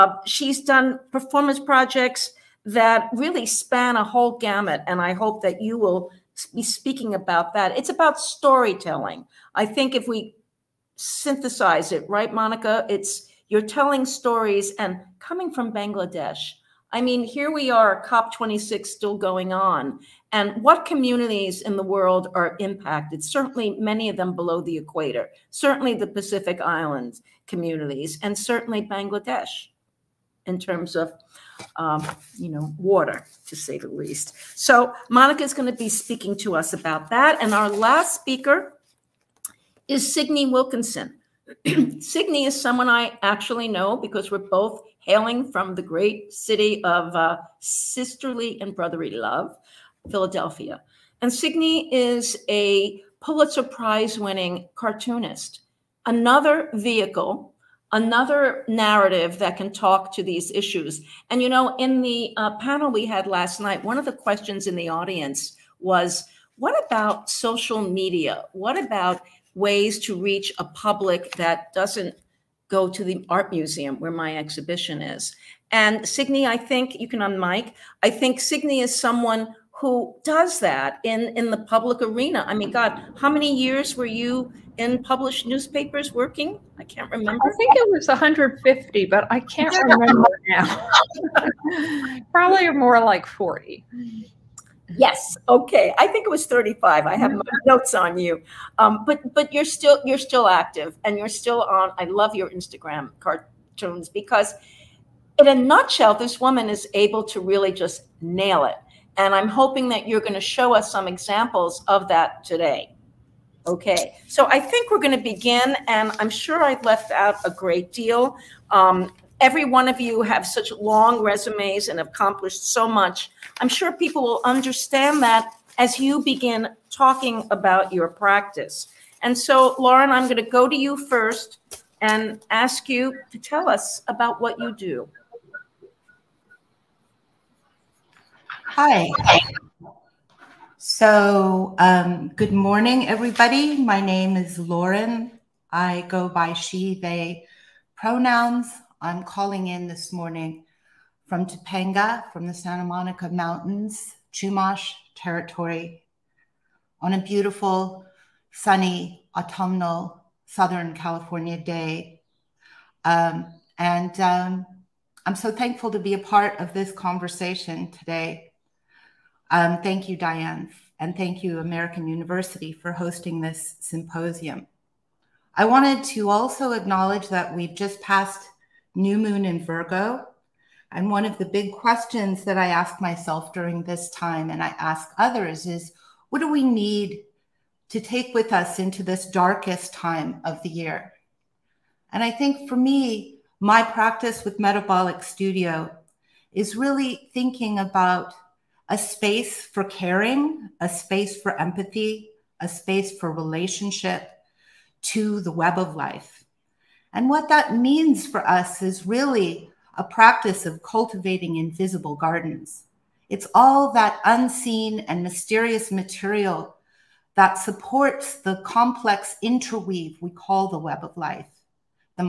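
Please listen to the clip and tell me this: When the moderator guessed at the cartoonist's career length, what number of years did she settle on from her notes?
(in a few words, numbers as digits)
35.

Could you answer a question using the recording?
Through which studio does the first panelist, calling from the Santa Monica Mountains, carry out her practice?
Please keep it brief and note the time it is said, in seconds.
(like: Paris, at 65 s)
Metabolic Studio, at 194 s.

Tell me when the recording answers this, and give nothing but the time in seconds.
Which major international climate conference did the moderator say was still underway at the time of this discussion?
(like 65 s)
18 s.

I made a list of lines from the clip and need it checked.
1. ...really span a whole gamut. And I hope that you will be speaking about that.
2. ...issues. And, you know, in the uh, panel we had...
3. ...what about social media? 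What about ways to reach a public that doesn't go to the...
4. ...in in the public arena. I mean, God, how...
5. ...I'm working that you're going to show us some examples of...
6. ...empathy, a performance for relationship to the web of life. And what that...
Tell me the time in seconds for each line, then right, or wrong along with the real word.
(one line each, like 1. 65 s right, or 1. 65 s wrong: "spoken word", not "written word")
1. 3 s right
2. 60 s right
3. 66 s right
4. 81 s right
5. 109 s wrong: "hoping", not "working"
6. 201 s wrong: "space", not "performance".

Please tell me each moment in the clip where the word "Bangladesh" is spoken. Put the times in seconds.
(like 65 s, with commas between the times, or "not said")
15 s, 28 s.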